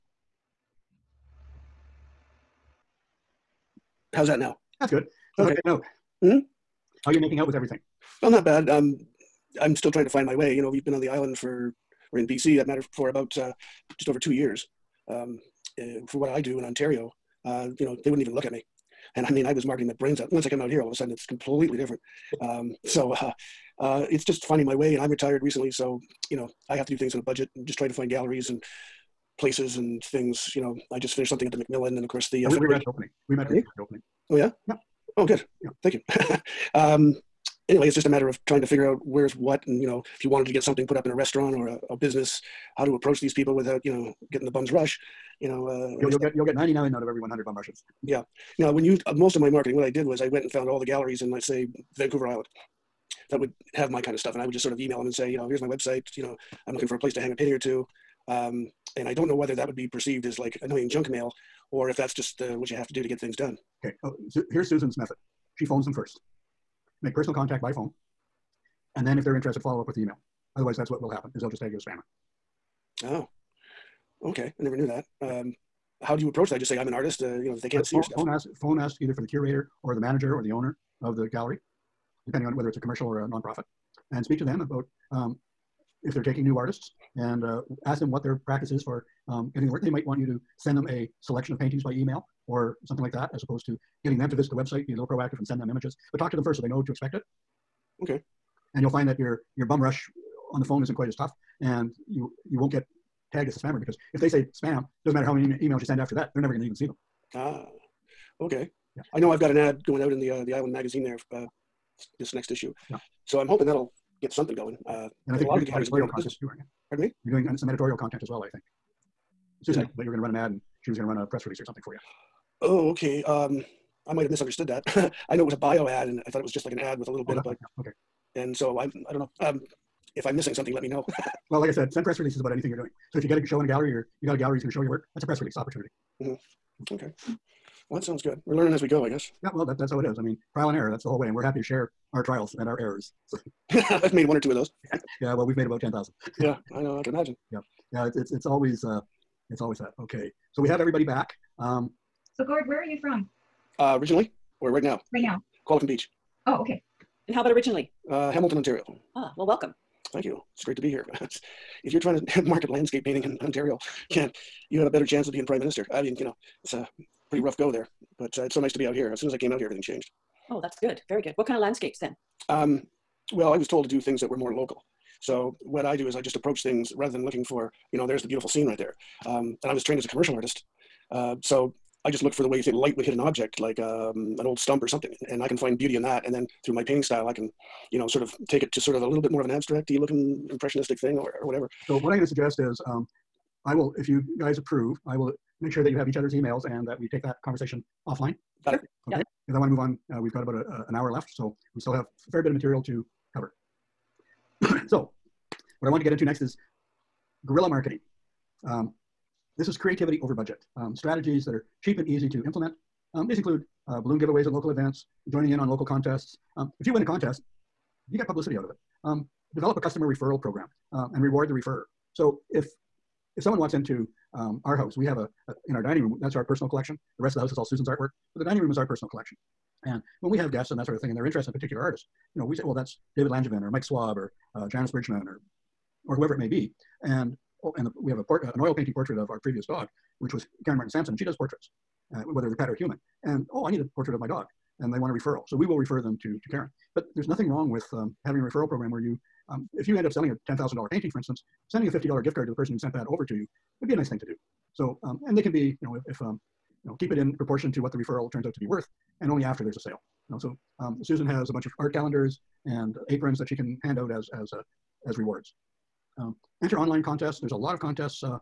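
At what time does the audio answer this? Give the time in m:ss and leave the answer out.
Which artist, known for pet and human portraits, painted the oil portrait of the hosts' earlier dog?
4:00.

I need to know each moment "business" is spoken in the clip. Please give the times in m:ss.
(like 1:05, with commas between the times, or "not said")
0:41.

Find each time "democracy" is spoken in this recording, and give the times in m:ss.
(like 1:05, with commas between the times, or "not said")
not said.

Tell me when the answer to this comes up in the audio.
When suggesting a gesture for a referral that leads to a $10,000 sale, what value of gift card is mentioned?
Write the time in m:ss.
4:11.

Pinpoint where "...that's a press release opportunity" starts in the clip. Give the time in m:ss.
2:15.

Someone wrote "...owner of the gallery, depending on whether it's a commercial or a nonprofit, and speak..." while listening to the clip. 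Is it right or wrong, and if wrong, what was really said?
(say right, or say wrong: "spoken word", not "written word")
right.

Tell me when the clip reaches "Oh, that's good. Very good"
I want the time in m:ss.
2:50.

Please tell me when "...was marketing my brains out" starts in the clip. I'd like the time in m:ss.
0:19.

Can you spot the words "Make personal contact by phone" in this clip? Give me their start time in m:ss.
1:07.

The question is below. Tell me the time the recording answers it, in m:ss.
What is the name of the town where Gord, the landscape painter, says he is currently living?
2:35.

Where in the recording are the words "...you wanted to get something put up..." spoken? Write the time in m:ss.
0:40.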